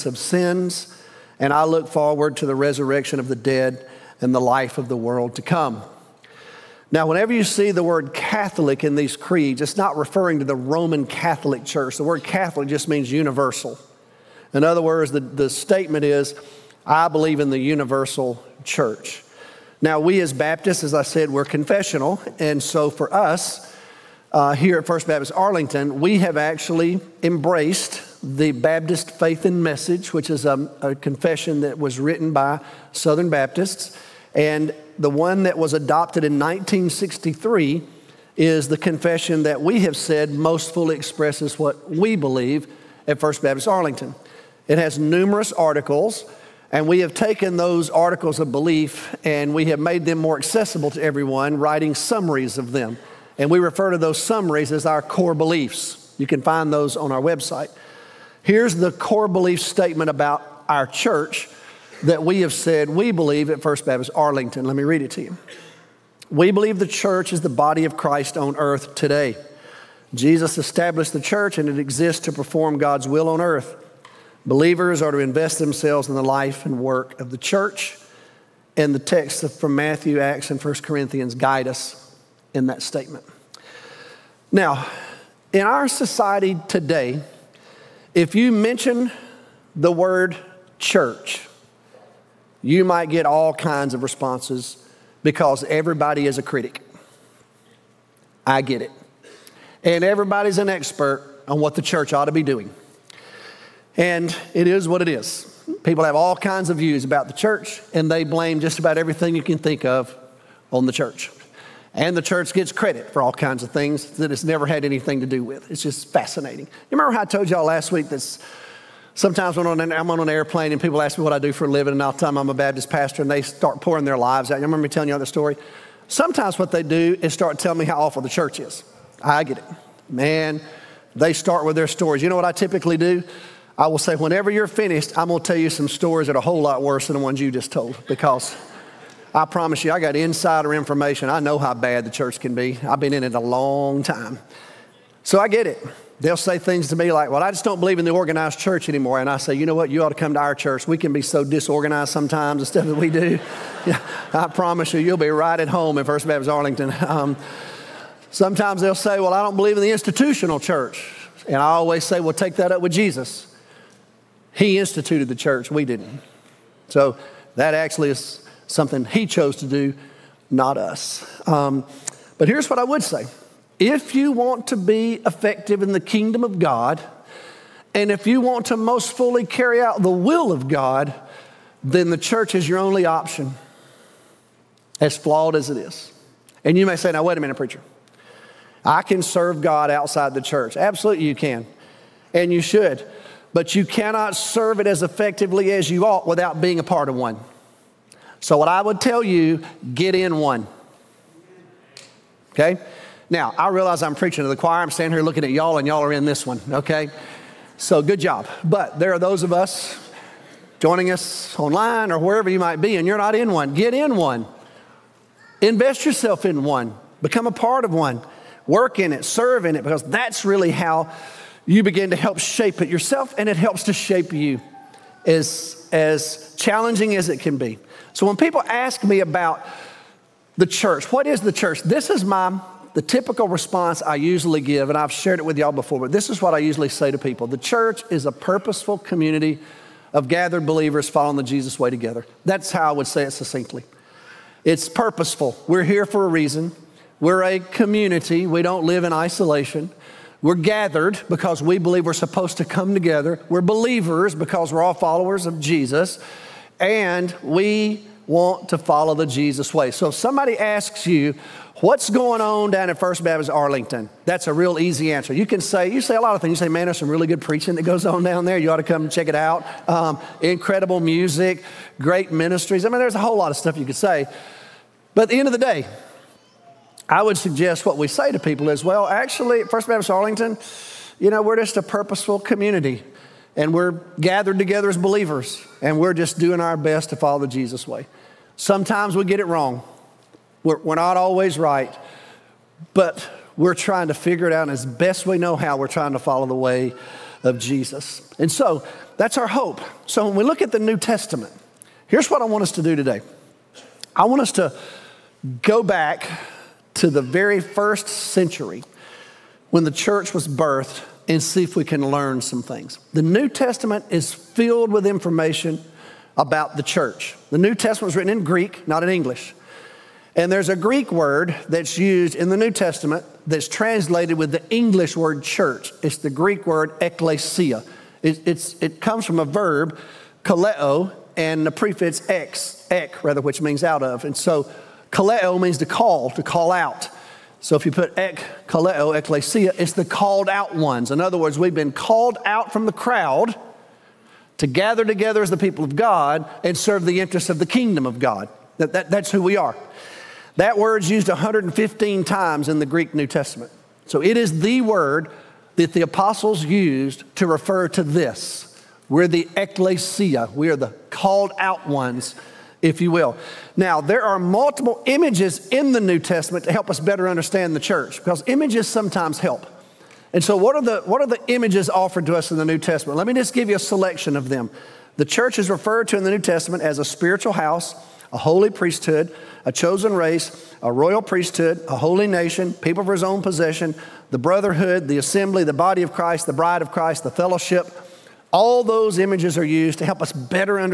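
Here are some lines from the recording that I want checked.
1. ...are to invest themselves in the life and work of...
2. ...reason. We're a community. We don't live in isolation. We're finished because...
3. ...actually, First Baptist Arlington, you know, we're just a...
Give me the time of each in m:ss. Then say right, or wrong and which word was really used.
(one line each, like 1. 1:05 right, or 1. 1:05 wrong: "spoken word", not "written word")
1. 1:15 right
2. 4:06 wrong: "gathered", not "finished"
3. 4:39 right.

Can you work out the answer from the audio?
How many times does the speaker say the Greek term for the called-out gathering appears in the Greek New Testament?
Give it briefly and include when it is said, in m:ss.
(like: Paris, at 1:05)
115, at 5:51.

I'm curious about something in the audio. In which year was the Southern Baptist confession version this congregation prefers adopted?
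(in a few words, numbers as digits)
1963.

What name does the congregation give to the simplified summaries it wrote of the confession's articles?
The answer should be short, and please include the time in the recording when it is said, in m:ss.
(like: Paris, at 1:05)
core beliefs, at 0:55.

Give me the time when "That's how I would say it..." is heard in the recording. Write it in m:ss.
4:02.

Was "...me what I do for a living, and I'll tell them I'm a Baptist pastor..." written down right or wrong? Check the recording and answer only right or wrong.
right.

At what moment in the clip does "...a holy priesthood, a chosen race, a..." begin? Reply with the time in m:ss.
6:18.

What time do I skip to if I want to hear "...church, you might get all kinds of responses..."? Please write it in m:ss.
1:30.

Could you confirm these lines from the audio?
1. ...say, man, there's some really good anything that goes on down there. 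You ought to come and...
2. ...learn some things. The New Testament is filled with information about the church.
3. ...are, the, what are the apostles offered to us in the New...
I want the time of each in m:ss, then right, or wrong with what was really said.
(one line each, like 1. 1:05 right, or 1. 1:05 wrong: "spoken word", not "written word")
1. 4:26 wrong: "preaching", not "anything"
2. 5:12 right
3. 6:10 wrong: "images", not "apostles".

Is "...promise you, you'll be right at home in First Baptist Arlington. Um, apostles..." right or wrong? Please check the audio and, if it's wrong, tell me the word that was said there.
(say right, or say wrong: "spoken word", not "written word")
wrong: "sometimes", not "apostles".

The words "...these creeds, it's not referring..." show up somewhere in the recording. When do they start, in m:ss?
0:08.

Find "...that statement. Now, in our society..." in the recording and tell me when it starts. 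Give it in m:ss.
1:22.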